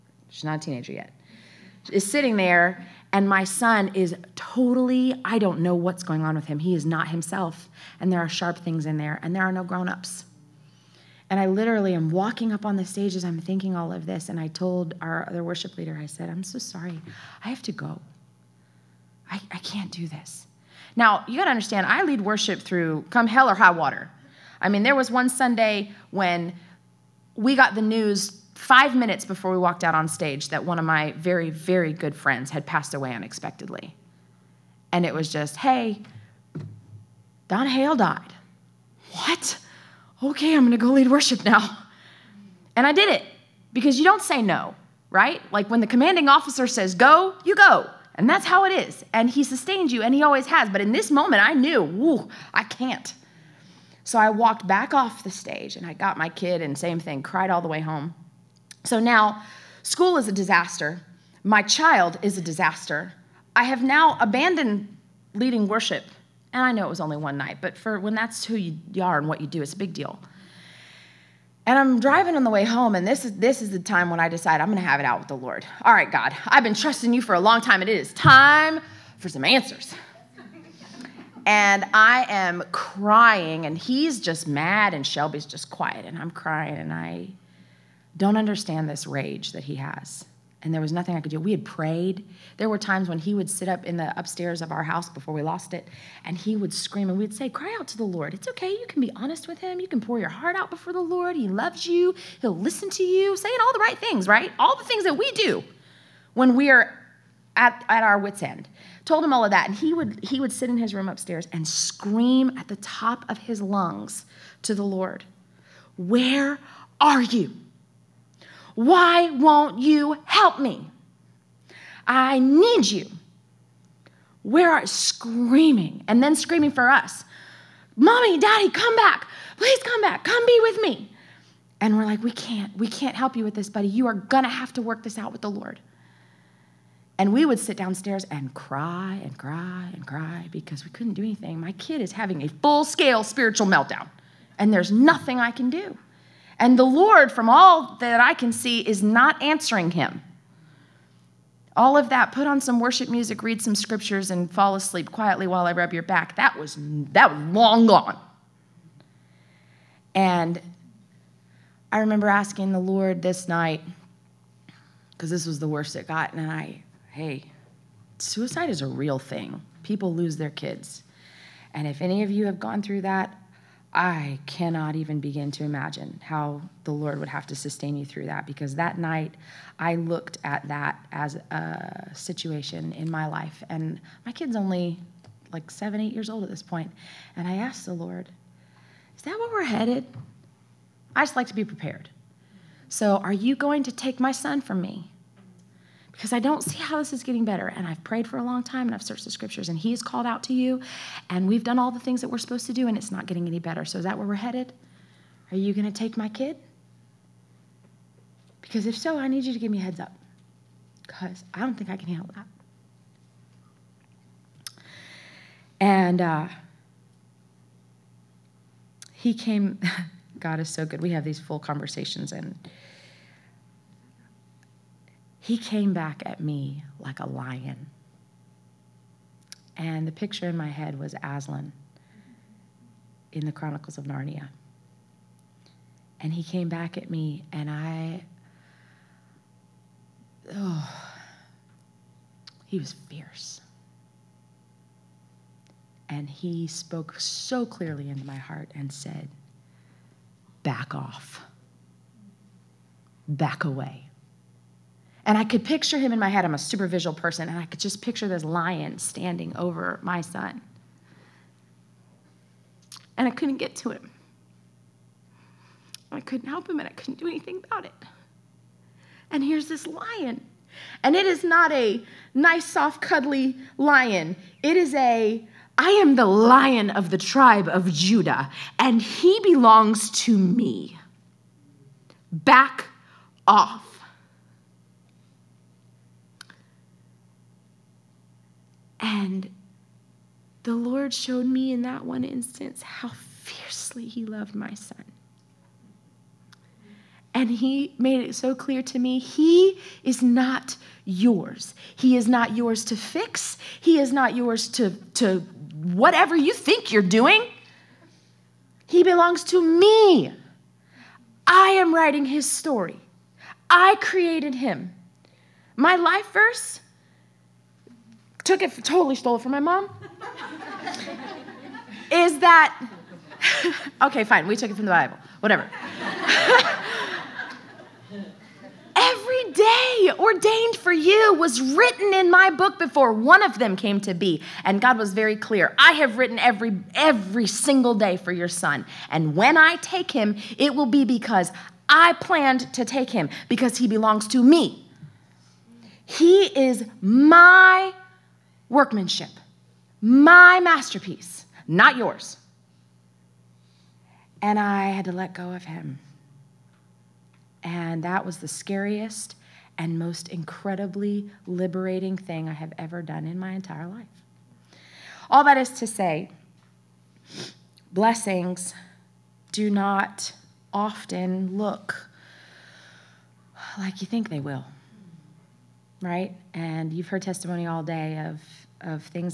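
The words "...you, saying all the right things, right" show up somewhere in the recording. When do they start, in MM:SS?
01:43.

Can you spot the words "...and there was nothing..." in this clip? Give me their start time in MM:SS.
01:30.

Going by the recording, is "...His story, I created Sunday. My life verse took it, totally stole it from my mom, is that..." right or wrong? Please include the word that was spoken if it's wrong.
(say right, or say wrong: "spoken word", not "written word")
wrong: "Him", not "Sunday".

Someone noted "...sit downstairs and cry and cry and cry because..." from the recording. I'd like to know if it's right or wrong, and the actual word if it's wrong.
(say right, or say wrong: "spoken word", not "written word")
right.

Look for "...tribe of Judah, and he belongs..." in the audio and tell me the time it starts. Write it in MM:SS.
04:37.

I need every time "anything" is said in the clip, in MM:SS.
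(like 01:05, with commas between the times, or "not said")
02:21, 04:27.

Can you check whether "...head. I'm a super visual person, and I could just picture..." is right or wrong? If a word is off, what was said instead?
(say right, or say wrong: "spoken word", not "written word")
right.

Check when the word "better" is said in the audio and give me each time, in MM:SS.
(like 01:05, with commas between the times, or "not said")
03:17, 03:23.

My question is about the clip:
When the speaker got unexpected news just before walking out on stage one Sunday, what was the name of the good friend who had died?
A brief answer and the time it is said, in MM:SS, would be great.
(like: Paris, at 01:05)
Don Hale, at 00:37.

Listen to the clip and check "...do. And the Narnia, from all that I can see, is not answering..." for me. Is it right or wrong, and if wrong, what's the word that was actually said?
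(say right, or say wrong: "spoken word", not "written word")
wrong: "Lord", not "Narnia".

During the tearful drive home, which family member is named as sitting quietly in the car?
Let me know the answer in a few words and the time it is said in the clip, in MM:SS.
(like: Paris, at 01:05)
Shelby, at 01:25.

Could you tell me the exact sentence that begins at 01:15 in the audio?
All right, God, I've been trusting you for a long time.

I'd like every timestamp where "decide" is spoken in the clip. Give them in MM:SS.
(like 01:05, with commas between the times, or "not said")
01:14.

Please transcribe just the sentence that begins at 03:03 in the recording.
And my kid's only like seven, eight years old at this point.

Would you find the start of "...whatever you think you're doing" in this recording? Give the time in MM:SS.
05:05.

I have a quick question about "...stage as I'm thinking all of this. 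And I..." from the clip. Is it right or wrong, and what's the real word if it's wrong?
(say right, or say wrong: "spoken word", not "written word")
right.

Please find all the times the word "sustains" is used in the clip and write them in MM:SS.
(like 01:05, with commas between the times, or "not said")
00:49, 02:57.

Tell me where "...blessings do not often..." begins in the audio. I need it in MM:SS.
06:07.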